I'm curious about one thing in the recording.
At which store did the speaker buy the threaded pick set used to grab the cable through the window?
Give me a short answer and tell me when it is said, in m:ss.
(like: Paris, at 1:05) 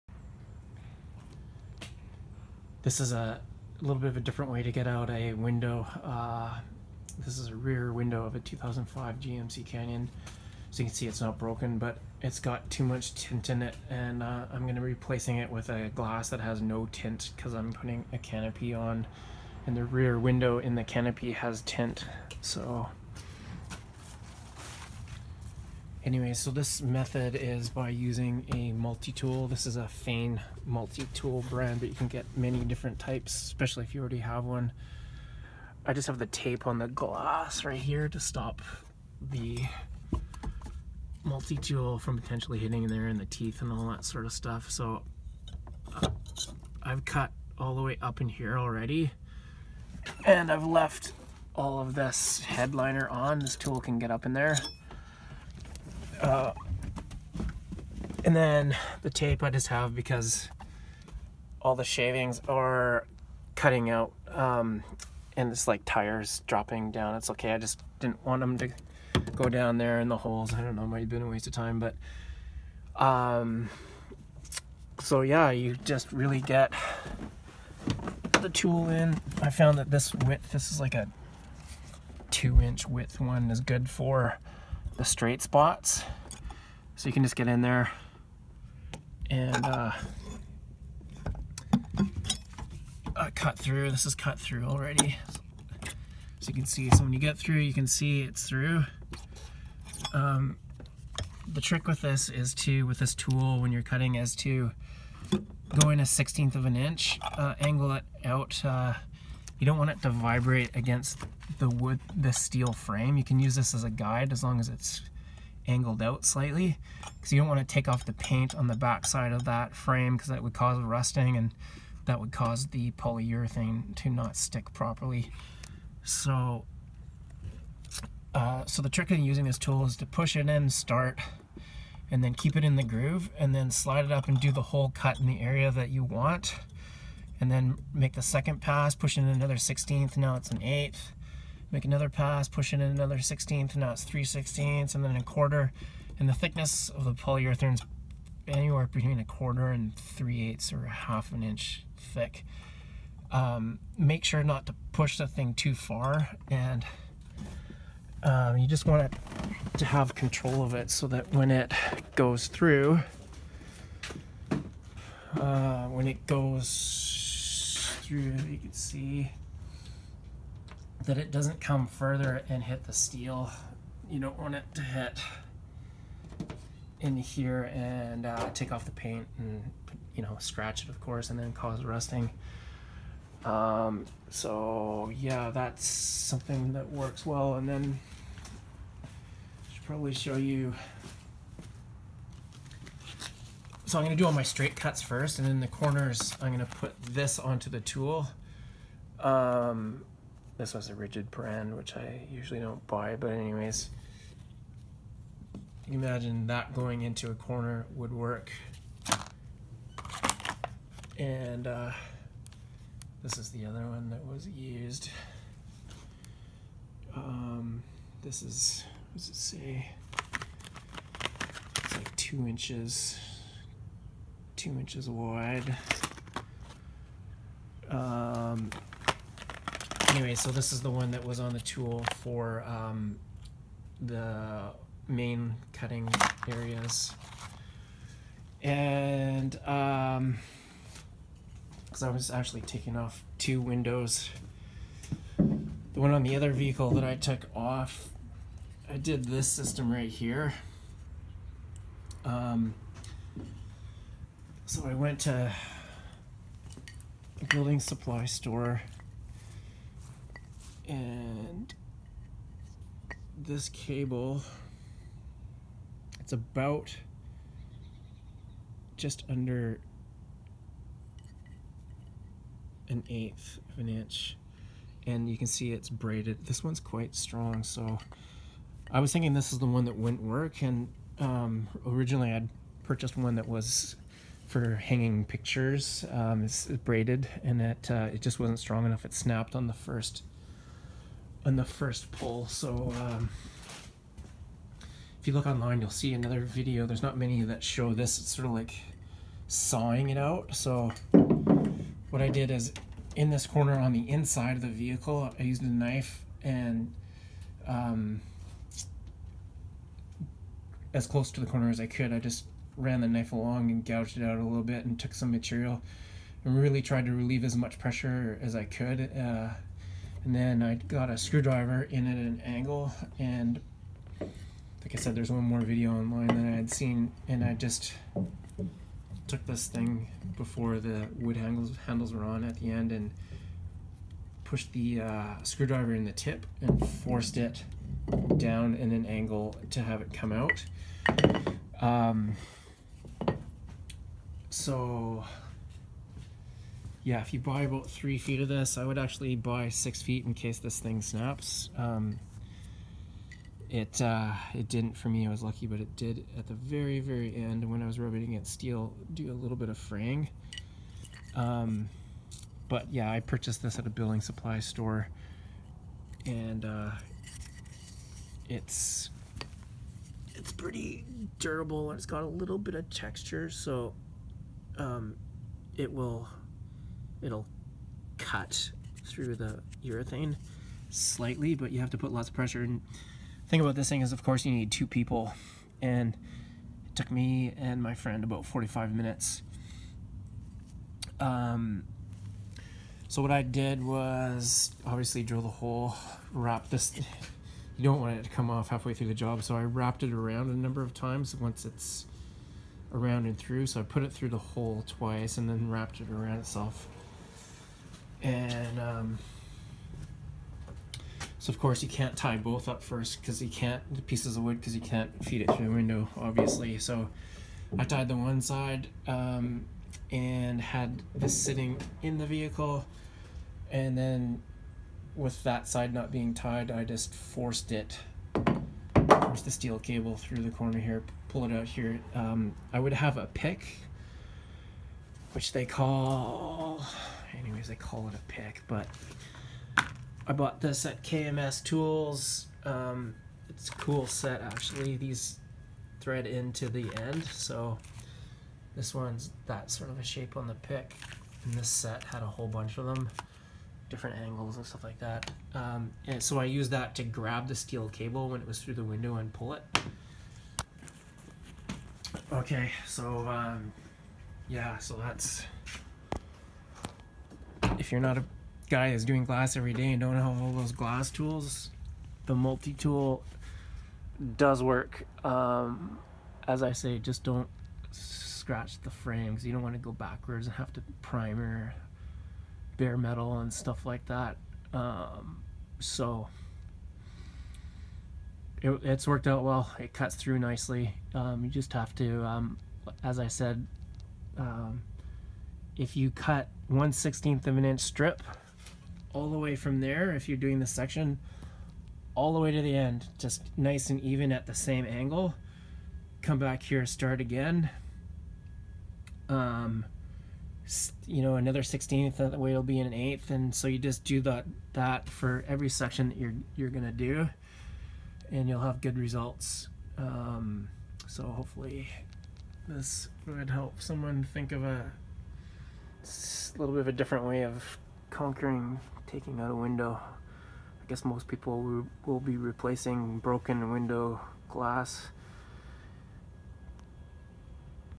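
KMS Tools, at 7:21.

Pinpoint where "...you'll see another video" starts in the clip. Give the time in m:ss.
4:55.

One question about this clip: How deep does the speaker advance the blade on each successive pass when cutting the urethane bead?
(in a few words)
1/16 of an inch.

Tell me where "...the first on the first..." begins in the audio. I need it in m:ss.
4:49.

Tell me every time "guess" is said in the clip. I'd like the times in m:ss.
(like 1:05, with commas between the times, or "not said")
8:50.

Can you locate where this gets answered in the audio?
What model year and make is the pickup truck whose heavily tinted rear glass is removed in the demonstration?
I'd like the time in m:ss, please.
0:08.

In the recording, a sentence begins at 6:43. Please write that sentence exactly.
So I put it through the hole twice and then wrapped it around itself.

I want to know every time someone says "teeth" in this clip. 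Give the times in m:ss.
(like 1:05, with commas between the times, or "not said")
0:43.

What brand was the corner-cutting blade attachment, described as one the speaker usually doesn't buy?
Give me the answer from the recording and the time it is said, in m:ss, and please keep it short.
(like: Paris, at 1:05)
Ridgid, at 3:20.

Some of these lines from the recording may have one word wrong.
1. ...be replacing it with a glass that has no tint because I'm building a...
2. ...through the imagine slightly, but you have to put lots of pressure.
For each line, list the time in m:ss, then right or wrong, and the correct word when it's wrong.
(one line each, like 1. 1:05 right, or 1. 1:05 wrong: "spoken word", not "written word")
1. 0:14 wrong: "putting", not "building"
2. 6:19 wrong: "urethane", not "imagine".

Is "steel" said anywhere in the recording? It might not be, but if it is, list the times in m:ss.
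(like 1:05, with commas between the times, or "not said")
1:52, 2:52, 5:58, 7:09, 7:37.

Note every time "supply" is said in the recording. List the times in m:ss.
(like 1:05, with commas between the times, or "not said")
4:17, 6:04.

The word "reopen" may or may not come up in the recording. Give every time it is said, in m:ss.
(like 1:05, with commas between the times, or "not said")
not said.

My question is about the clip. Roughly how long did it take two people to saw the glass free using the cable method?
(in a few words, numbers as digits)
45 minutes.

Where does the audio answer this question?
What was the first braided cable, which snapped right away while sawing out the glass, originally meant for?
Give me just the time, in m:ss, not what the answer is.
4:44.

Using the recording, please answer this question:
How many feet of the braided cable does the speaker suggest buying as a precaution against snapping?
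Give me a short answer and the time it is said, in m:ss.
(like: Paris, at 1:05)
6 feet, at 5:49.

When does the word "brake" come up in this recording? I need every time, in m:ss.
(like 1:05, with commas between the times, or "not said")
not said.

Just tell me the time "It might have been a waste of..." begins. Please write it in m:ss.
1:10.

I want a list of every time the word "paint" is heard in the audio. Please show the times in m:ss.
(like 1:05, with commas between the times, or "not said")
1:58, 2:58.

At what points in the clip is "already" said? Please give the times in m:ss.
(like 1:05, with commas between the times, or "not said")
0:34, 0:48, 1:34.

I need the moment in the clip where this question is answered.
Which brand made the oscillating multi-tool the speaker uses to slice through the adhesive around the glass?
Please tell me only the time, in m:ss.
0:29.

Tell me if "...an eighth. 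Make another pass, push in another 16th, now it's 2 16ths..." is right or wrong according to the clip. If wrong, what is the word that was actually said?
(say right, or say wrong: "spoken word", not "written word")
wrong: "3", not "2".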